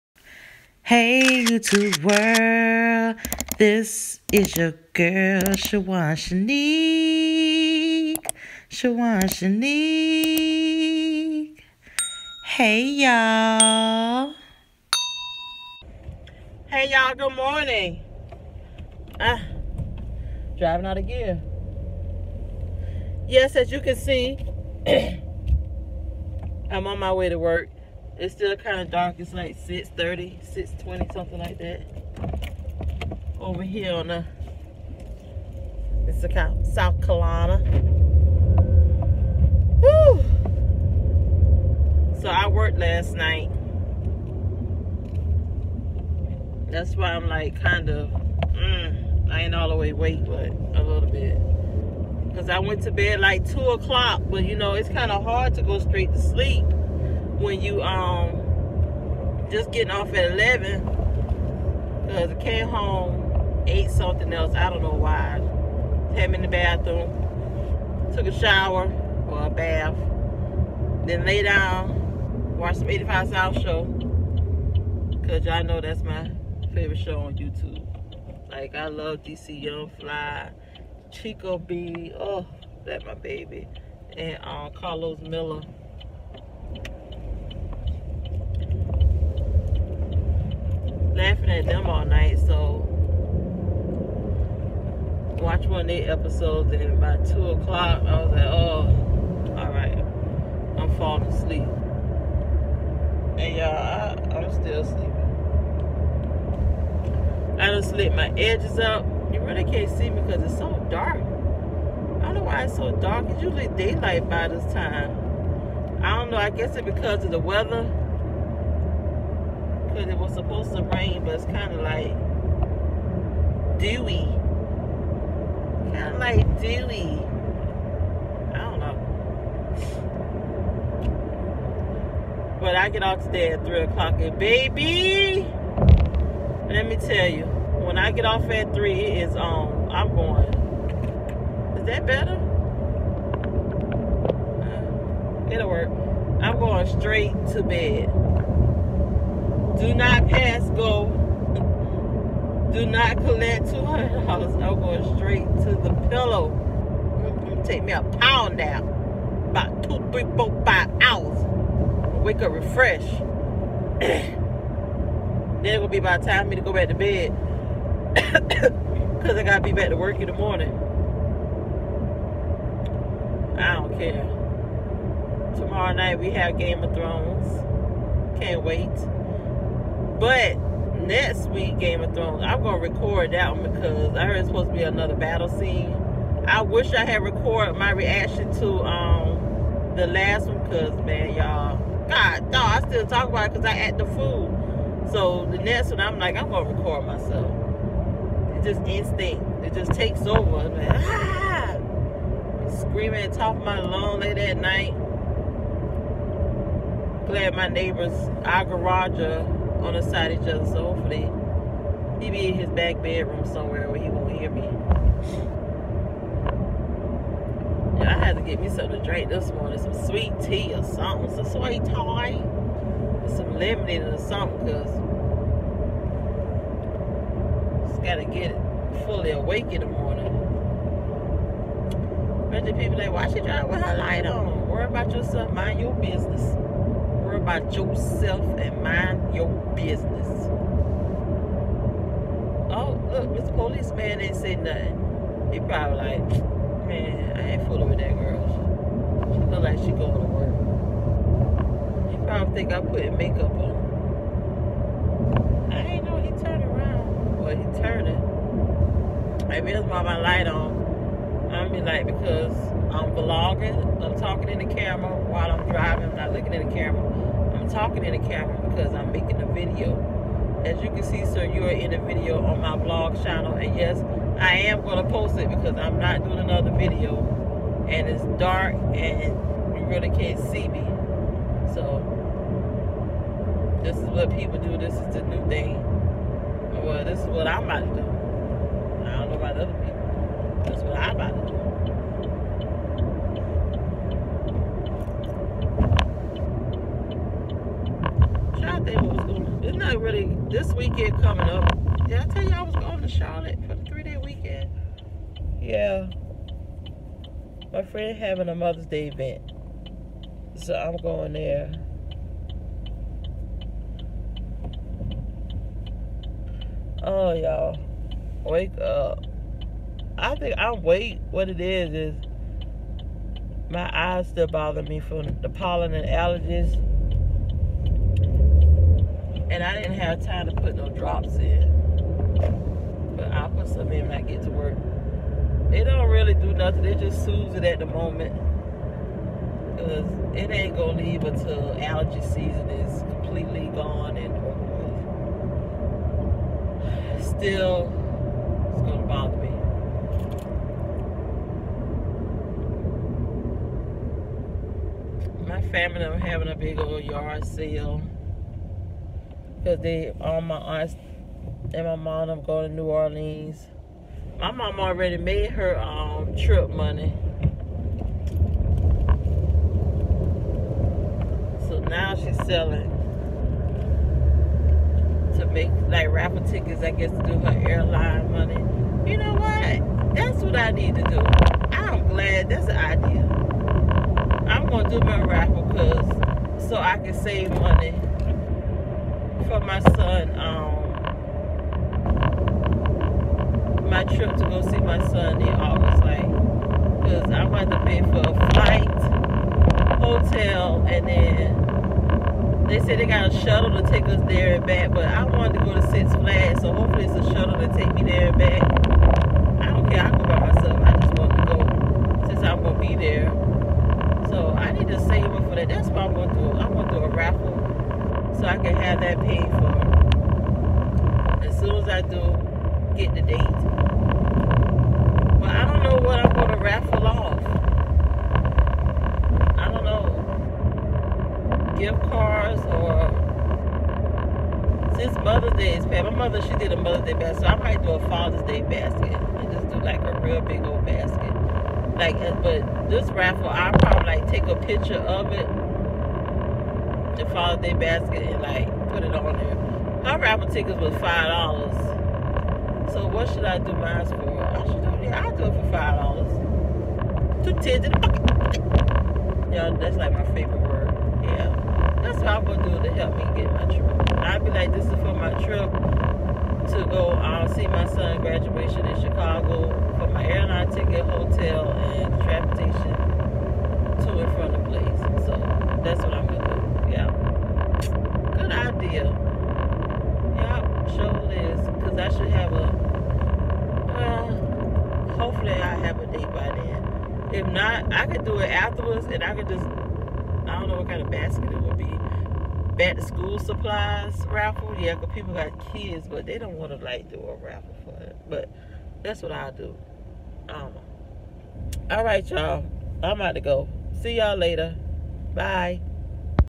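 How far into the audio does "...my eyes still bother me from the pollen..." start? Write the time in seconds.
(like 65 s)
323 s.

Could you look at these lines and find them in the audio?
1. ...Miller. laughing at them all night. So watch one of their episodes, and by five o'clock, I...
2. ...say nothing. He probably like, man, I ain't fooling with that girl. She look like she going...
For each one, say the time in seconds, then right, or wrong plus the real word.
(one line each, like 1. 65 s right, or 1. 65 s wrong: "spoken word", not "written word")
1. 85 s wrong: "two", not "five"
2. 244 s right.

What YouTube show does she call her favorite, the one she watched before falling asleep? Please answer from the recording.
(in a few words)
85 South.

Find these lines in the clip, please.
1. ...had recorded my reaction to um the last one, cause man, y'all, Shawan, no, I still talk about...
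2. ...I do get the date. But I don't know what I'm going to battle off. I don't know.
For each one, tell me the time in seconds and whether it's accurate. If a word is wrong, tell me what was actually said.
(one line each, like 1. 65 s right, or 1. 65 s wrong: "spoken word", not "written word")
1. 187 s wrong: "God", not "Shawan"
2. 421 s wrong: "raffle", not "battle".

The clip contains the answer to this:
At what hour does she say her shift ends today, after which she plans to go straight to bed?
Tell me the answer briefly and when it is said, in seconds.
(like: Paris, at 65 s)
3 o'clock, at 133 s.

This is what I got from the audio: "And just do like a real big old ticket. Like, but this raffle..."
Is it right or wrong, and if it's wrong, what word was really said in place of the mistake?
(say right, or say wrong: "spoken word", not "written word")
wrong: "basket", not "ticket".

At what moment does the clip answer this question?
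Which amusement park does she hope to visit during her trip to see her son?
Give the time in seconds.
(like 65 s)
405 s.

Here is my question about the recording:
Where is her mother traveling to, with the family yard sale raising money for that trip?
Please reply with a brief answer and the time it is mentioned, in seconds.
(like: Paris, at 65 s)
New Orleans, at 362 s.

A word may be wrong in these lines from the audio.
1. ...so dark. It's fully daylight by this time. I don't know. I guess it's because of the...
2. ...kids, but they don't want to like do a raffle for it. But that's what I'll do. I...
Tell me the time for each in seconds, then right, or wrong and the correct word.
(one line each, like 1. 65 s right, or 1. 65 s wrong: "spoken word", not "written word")
1. 112 s wrong: "usually", not "fully"
2. 495 s right.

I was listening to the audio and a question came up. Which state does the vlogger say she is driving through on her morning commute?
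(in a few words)
South Carolina.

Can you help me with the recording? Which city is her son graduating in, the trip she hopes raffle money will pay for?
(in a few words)
Chicago.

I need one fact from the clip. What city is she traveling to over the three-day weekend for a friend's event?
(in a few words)
Charlotte.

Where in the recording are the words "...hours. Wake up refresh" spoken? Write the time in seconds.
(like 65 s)
161 s.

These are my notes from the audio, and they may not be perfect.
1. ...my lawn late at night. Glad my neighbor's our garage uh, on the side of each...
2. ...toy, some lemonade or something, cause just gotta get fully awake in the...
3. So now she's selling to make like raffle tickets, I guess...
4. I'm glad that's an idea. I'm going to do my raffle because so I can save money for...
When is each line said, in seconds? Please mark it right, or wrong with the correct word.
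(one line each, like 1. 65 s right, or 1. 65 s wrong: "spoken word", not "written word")
1. 203 s right
2. 221 s right
3. 371 s right
4. 381 s right.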